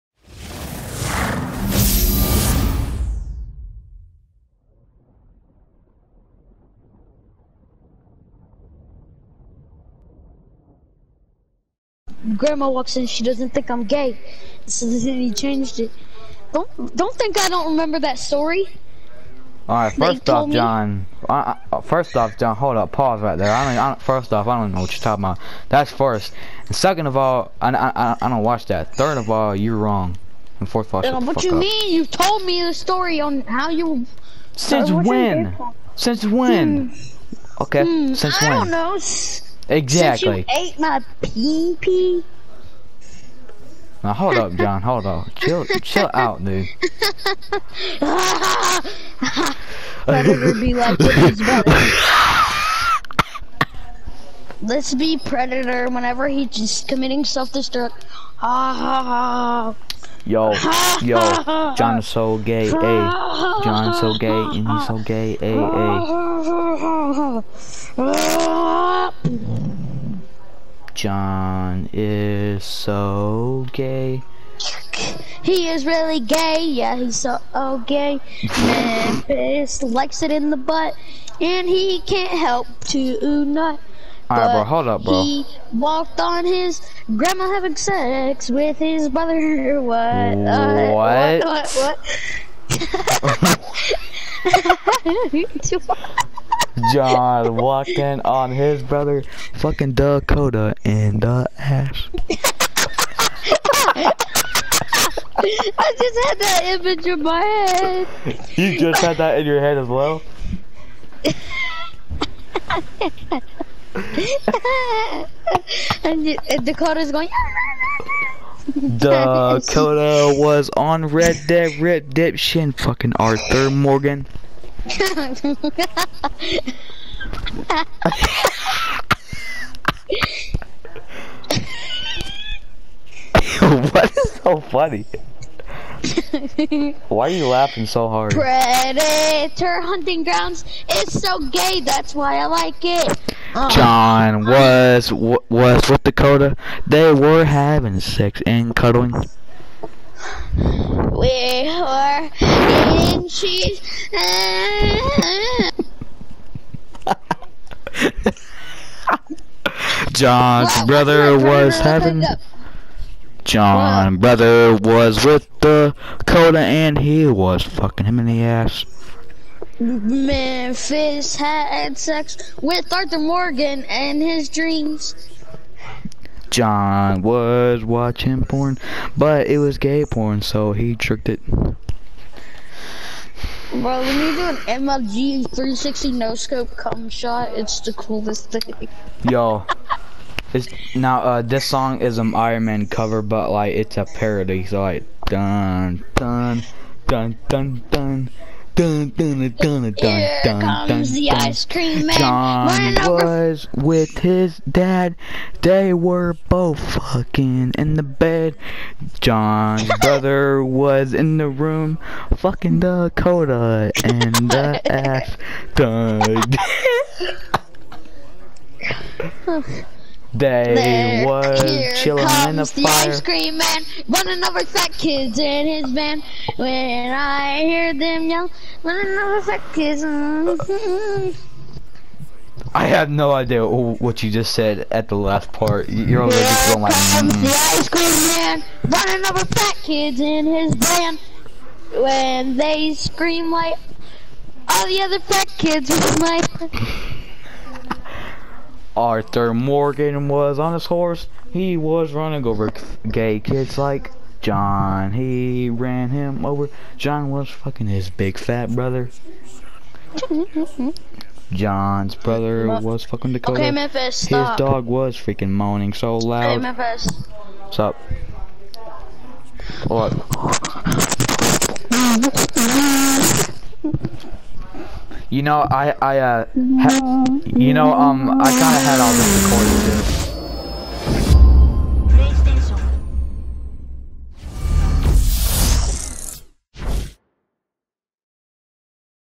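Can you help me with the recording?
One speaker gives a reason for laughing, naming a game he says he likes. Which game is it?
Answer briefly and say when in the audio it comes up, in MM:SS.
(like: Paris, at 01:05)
Predator: Hunting Grounds, at 02:18.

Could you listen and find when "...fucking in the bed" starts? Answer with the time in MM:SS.
03:26.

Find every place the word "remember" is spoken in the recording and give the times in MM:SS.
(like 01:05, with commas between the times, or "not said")
00:17.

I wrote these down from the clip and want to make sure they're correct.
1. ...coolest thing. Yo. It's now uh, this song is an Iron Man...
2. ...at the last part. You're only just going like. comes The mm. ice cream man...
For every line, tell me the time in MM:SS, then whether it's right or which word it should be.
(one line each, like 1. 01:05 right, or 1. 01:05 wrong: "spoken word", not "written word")
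1. 03:07 right
2. 03:54 right.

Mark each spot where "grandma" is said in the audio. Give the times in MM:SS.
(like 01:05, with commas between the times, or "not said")
00:12, 01:27.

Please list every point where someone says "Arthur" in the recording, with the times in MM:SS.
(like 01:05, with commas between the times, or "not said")
02:03, 02:52, 04:08.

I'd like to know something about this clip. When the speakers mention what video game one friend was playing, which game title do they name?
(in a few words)
Red Dead Redemption.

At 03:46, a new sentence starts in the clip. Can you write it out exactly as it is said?
When I hear them yell, running over fat kids.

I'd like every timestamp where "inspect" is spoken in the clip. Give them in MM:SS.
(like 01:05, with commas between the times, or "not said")
not said.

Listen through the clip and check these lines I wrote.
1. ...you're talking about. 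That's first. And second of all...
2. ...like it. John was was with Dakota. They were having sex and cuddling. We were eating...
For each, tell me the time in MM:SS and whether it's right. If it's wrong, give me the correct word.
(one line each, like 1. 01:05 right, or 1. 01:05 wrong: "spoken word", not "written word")
1. 00:24 right
2. 02:22 right.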